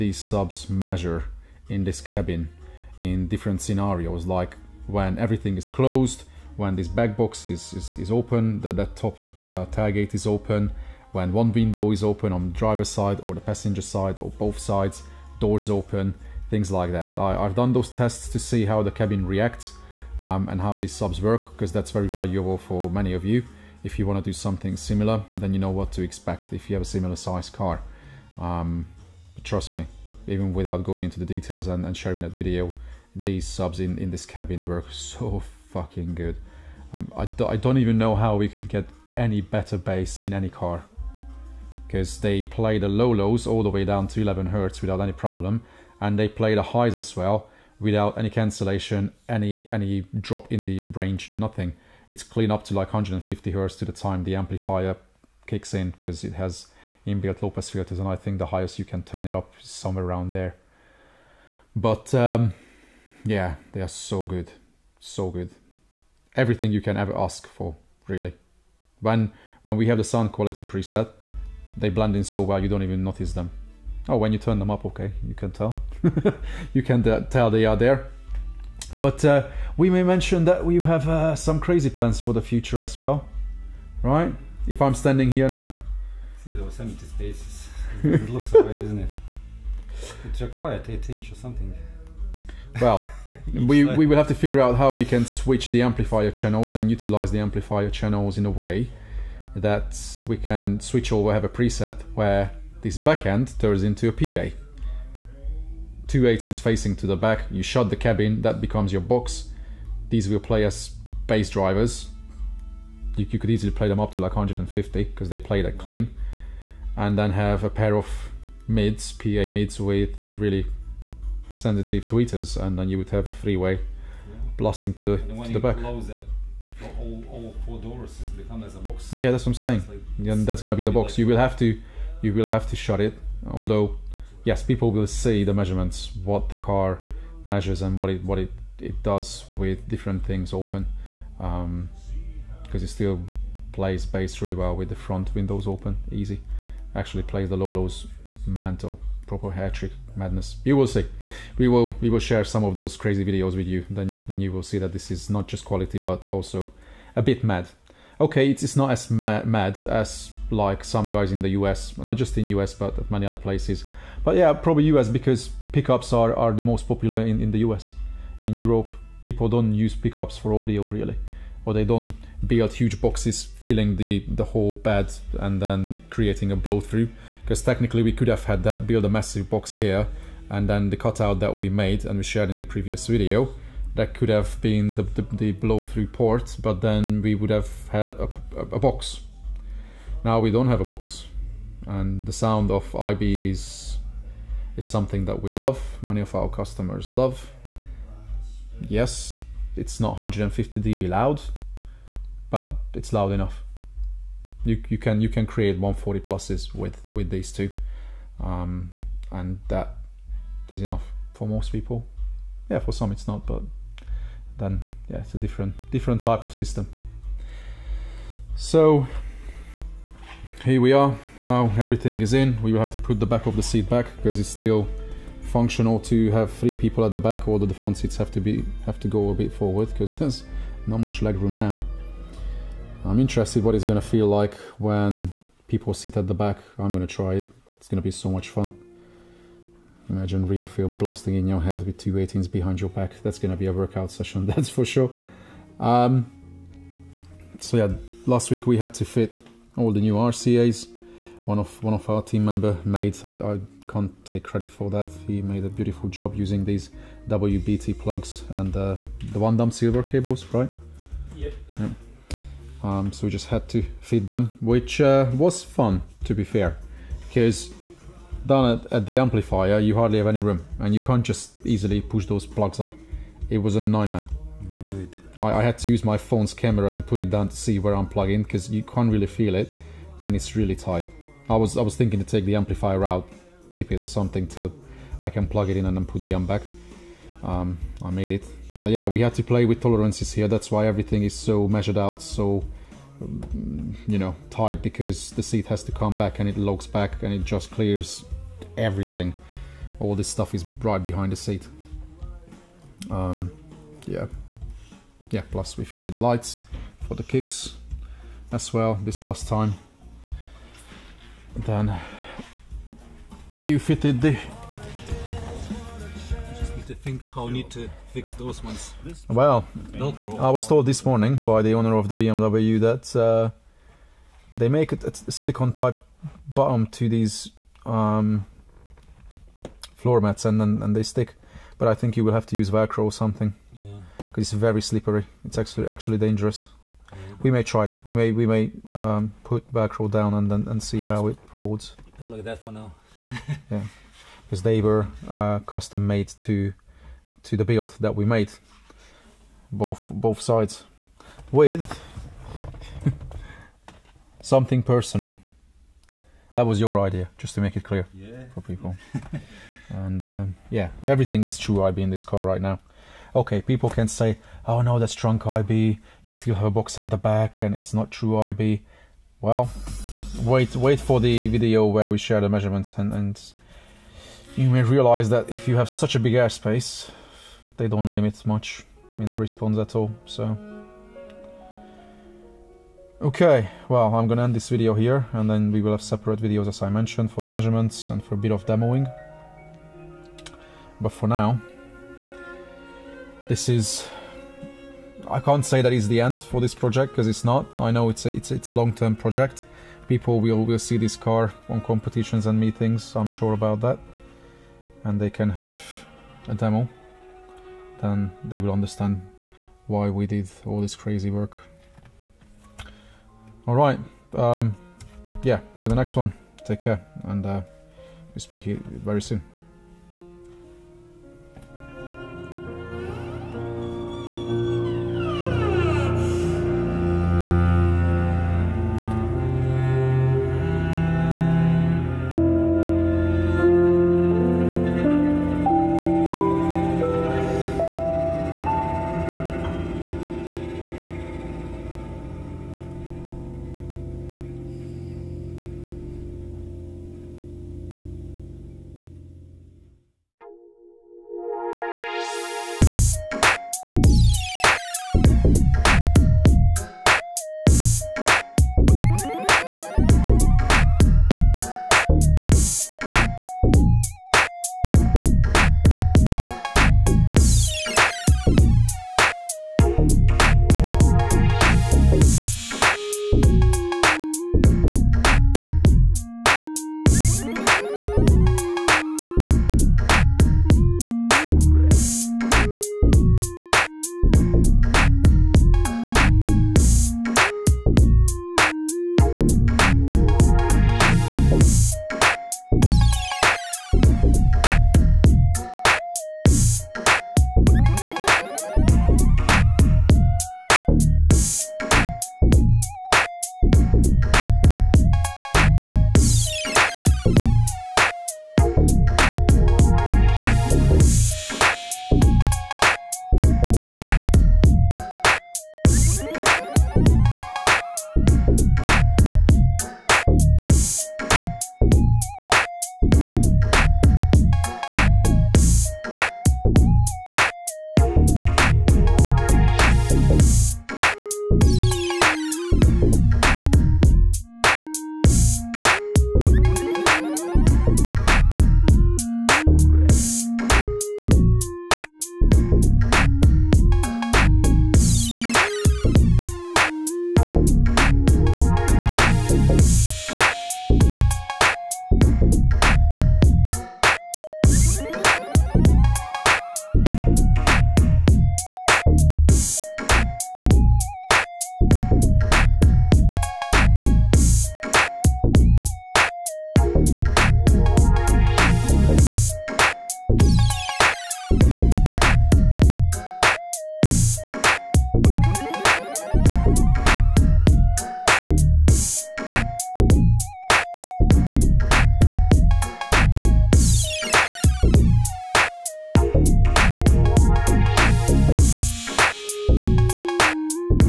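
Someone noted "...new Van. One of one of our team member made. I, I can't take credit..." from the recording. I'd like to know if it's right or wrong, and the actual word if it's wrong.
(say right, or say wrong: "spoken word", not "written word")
wrong: "RCAs", not "Van".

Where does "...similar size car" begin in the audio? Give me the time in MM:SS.
00:26.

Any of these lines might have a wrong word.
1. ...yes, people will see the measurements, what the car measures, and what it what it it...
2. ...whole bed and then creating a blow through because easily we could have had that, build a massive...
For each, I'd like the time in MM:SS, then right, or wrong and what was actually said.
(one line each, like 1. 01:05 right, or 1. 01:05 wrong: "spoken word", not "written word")
1. 02:14 right
2. 02:54 wrong: "technically", not "easily".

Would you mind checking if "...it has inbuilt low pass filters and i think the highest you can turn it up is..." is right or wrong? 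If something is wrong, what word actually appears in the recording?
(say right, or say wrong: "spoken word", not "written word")
right.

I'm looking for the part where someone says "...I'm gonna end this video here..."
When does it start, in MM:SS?
06:24.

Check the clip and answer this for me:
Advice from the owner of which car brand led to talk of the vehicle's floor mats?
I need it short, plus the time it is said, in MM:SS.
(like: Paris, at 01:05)
BMW, at 05:22.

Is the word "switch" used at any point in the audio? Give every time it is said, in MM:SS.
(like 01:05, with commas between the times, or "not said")
01:35, 01:40.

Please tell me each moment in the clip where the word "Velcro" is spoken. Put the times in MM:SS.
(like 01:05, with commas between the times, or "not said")
05:32, 05:39.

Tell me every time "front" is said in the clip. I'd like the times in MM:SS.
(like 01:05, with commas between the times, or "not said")
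02:24, 03:47.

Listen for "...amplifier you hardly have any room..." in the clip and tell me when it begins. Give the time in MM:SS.
04:29.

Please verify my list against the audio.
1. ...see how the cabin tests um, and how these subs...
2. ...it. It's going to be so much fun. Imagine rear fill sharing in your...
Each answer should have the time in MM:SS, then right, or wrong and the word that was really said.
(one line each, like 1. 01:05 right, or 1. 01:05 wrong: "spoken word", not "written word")
1. 00:18 wrong: "reacts", not "tests"
2. 03:57 wrong: "blasting", not "sharing".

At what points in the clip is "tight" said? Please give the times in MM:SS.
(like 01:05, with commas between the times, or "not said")
04:40, 04:54.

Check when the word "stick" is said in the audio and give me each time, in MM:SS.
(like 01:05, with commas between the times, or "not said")
05:31.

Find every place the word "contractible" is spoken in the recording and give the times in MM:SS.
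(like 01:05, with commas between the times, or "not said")
not said.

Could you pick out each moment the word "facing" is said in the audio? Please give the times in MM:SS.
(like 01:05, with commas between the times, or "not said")
01:46.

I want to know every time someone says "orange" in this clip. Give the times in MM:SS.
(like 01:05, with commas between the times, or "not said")
not said.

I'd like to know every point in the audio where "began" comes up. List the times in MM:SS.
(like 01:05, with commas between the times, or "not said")
not said.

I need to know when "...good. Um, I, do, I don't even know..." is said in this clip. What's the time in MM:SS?
00:36.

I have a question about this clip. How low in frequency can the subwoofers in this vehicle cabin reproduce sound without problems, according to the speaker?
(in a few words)
11 Hz.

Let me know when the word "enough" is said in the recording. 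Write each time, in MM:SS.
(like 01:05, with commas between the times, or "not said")
03:23, 03:30.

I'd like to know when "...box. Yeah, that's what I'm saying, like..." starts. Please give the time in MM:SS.
02:08.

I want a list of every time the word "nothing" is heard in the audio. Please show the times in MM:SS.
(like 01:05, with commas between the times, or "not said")
00:51.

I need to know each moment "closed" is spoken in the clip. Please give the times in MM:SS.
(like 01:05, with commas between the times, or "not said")
00:05.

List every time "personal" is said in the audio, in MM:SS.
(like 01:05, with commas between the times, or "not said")
05:54.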